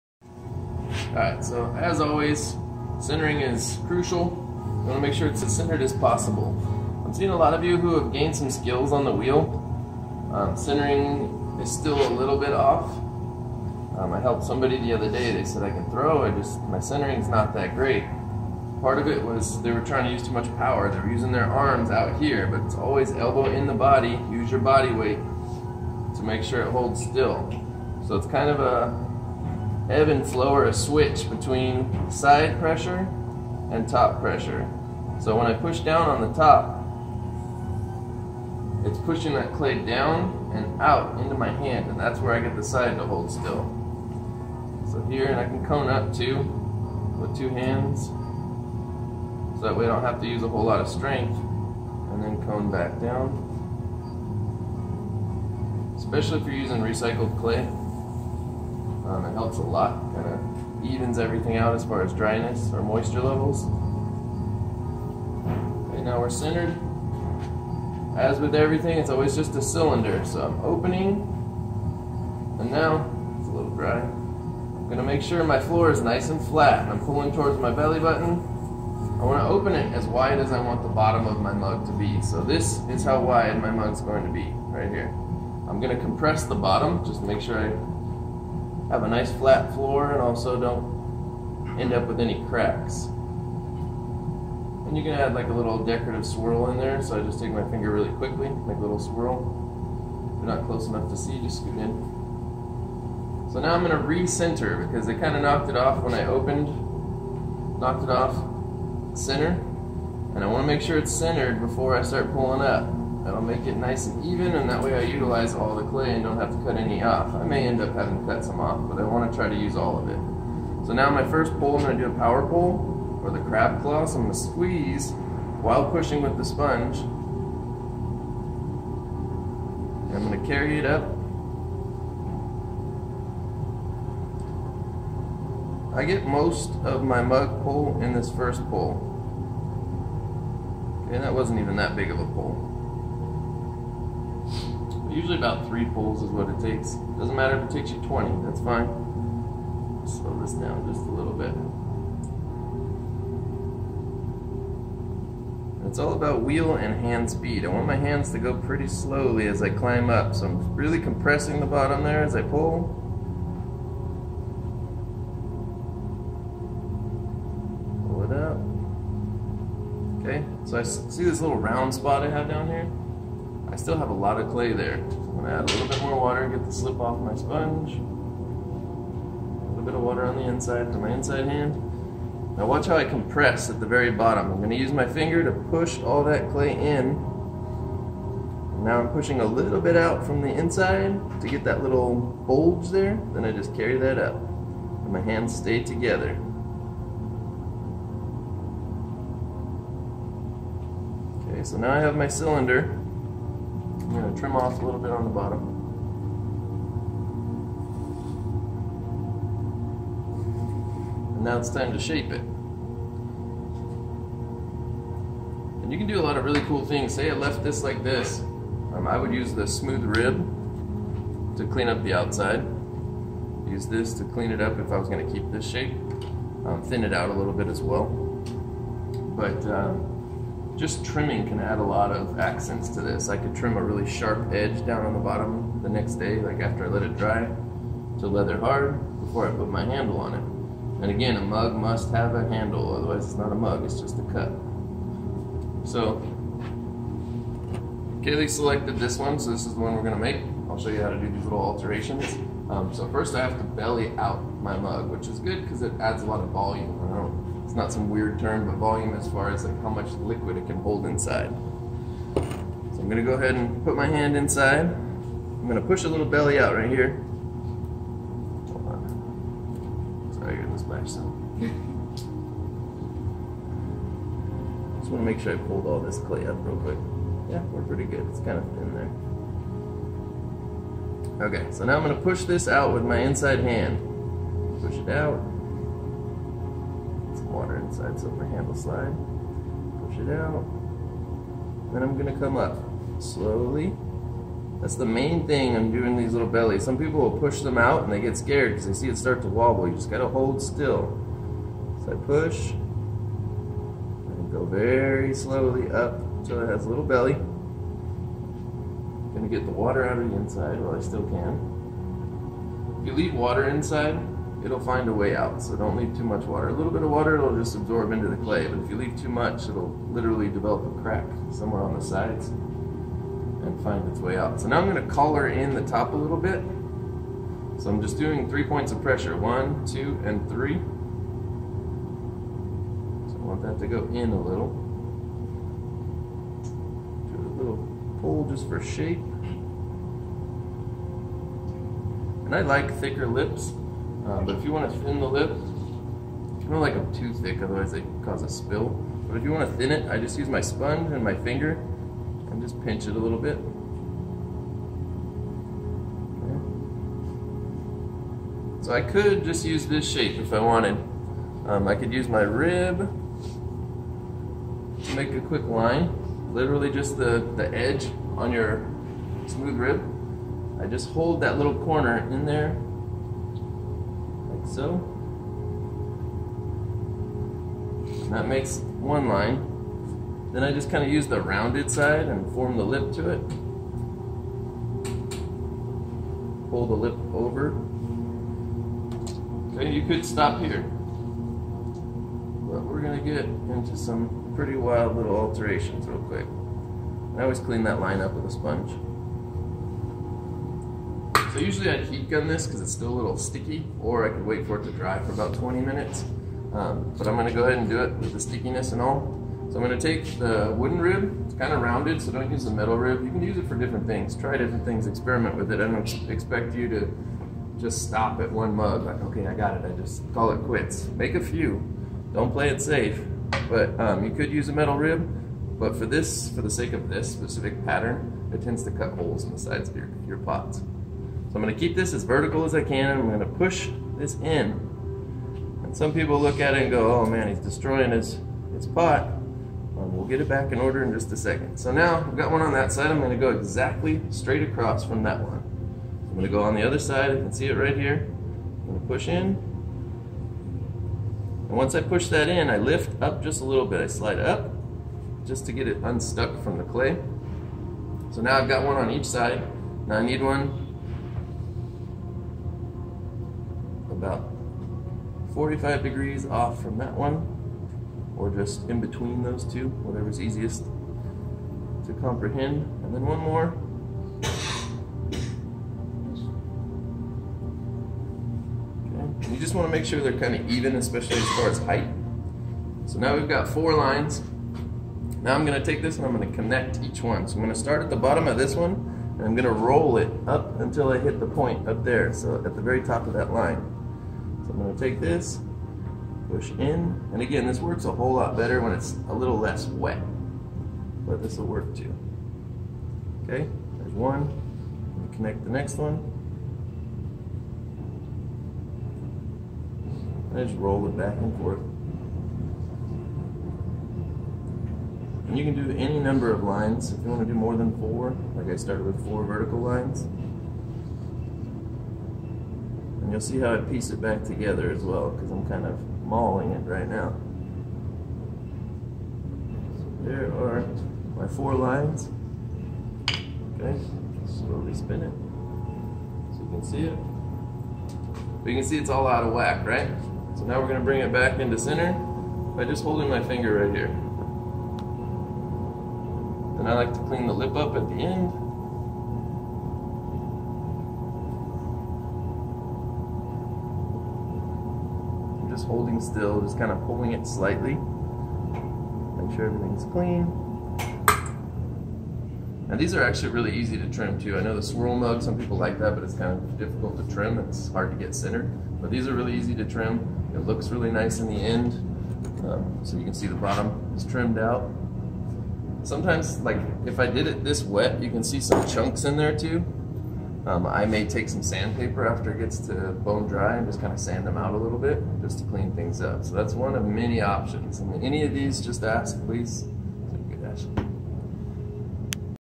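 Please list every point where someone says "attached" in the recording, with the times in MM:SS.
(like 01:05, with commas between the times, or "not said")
not said.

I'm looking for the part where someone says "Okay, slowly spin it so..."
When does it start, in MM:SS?
08:53.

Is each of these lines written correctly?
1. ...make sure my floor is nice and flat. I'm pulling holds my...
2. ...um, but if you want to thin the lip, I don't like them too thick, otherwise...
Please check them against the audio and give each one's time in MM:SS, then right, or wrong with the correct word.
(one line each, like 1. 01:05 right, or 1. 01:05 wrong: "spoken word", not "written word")
1. 01:15 wrong: "towards", not "holds"
2. 05:44 right.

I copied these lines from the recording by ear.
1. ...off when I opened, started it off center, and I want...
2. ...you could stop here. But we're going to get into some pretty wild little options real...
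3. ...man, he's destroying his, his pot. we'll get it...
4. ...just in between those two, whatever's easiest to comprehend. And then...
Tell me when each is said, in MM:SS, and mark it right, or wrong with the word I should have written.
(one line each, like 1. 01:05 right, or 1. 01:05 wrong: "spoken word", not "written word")
1. 01:45 wrong: "knocked", not "started"
2. 06:29 wrong: "alterations", not "options"
3. 07:17 right
4. 07:48 right.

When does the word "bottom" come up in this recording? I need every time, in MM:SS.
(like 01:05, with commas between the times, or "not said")
01:20, 01:26, 02:41, 03:04, 03:25, 03:55, 08:08, 09:33.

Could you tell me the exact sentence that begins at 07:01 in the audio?
Make a few, don't play it safe.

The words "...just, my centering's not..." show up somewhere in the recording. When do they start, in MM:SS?
00:16.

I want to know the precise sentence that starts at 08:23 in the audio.
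Okay, there's one, connect the next one.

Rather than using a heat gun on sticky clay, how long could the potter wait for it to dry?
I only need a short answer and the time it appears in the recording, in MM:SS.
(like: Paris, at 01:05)
20 minutes, at 06:45.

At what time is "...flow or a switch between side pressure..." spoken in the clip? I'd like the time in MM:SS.
00:30.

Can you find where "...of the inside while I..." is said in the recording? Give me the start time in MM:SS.
05:10.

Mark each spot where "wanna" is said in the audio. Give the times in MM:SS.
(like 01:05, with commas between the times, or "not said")
01:19, 04:35.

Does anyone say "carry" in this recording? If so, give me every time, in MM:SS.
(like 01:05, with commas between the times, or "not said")
02:10, 03:13.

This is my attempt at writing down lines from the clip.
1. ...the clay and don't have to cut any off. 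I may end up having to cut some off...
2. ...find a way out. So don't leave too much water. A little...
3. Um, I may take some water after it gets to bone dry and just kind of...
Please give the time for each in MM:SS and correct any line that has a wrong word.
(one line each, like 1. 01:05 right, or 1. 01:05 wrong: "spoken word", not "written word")
1. 01:55 right
2. 05:14 right
3. 09:40 wrong: "sandpaper", not "water".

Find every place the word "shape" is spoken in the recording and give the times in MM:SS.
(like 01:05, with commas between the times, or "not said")
03:31, 03:45, 05:38, 06:00.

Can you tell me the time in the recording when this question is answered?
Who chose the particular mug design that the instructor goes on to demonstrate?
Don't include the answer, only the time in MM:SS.
04:08.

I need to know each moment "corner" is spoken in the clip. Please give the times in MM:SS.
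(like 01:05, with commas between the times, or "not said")
06:11.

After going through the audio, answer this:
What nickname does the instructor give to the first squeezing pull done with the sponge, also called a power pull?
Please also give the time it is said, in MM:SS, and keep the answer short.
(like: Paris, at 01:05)
crab claw, at 02:03.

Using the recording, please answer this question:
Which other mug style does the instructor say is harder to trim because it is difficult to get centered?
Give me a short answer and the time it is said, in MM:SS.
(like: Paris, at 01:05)
swirl mug, at 09:24.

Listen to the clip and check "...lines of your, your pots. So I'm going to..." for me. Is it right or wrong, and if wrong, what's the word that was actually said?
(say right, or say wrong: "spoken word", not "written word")
wrong: "sides", not "lines".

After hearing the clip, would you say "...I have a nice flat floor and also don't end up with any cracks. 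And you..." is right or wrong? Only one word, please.
right.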